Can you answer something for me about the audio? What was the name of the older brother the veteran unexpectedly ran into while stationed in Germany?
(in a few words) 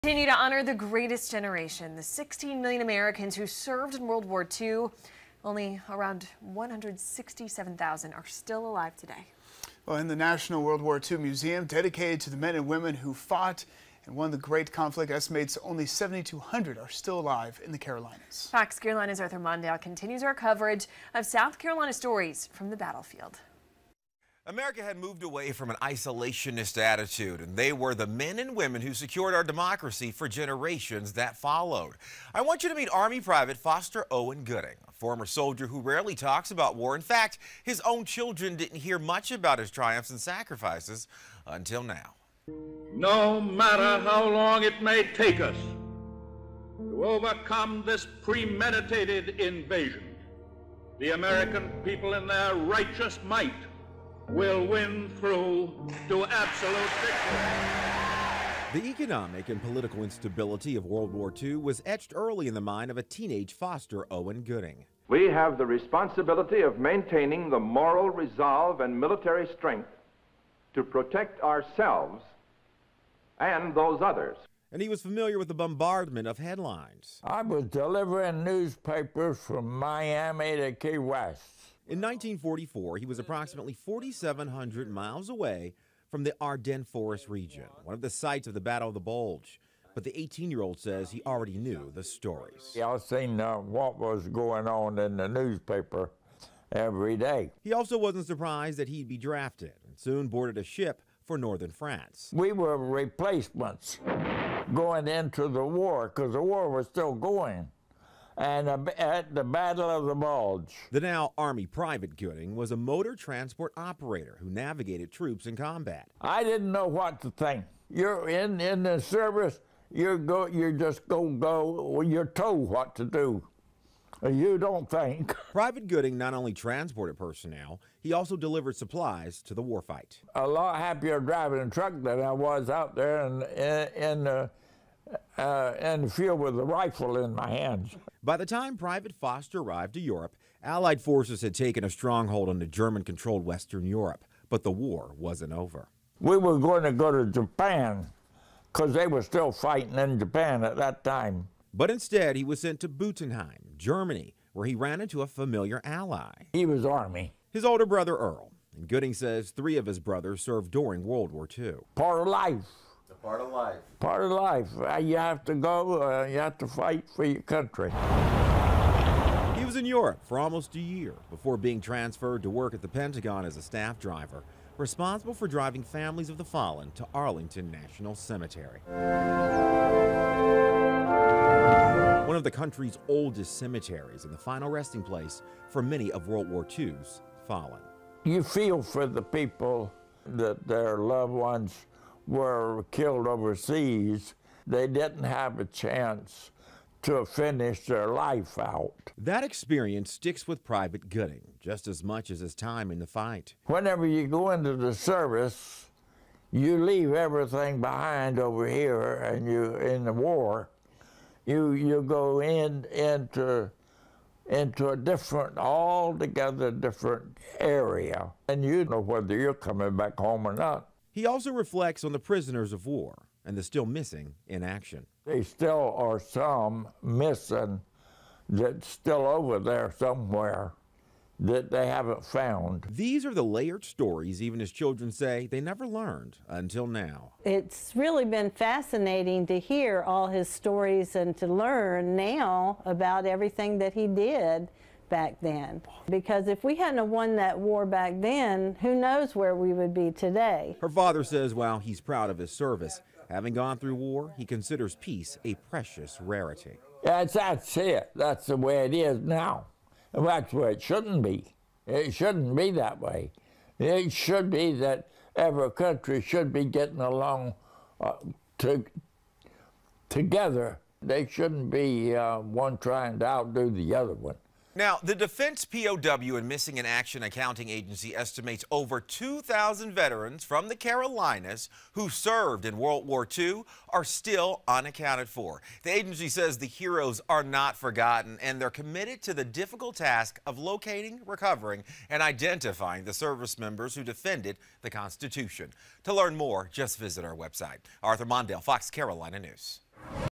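Earl.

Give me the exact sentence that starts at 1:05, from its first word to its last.
We have the responsibility of maintaining the moral resolve and military strength to protect ourselves and those others.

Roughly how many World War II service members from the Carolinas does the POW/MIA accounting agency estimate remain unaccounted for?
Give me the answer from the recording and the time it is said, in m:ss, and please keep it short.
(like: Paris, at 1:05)
over 2,000, at 4:38.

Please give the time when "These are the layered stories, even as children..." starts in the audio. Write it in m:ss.
3:52.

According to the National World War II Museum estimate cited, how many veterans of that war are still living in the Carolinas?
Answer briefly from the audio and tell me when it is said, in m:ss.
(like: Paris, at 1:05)
7,200, at 0:15.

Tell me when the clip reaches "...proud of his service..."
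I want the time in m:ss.
4:12.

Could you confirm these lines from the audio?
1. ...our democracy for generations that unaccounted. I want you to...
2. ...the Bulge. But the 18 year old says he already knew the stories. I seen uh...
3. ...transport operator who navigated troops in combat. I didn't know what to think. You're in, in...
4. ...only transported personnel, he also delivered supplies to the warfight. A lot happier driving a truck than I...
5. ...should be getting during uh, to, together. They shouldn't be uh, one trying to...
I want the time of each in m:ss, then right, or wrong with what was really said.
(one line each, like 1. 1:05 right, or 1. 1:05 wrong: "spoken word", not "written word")
1. 0:29 wrong: "followed", not "unaccounted"
2. 1:28 right
3. 1:53 right
4. 2:06 right
5. 4:26 wrong: "along", not "during".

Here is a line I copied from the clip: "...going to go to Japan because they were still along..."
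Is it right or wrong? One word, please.
wrong.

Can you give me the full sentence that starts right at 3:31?
You you go in into into a different, altogether different area.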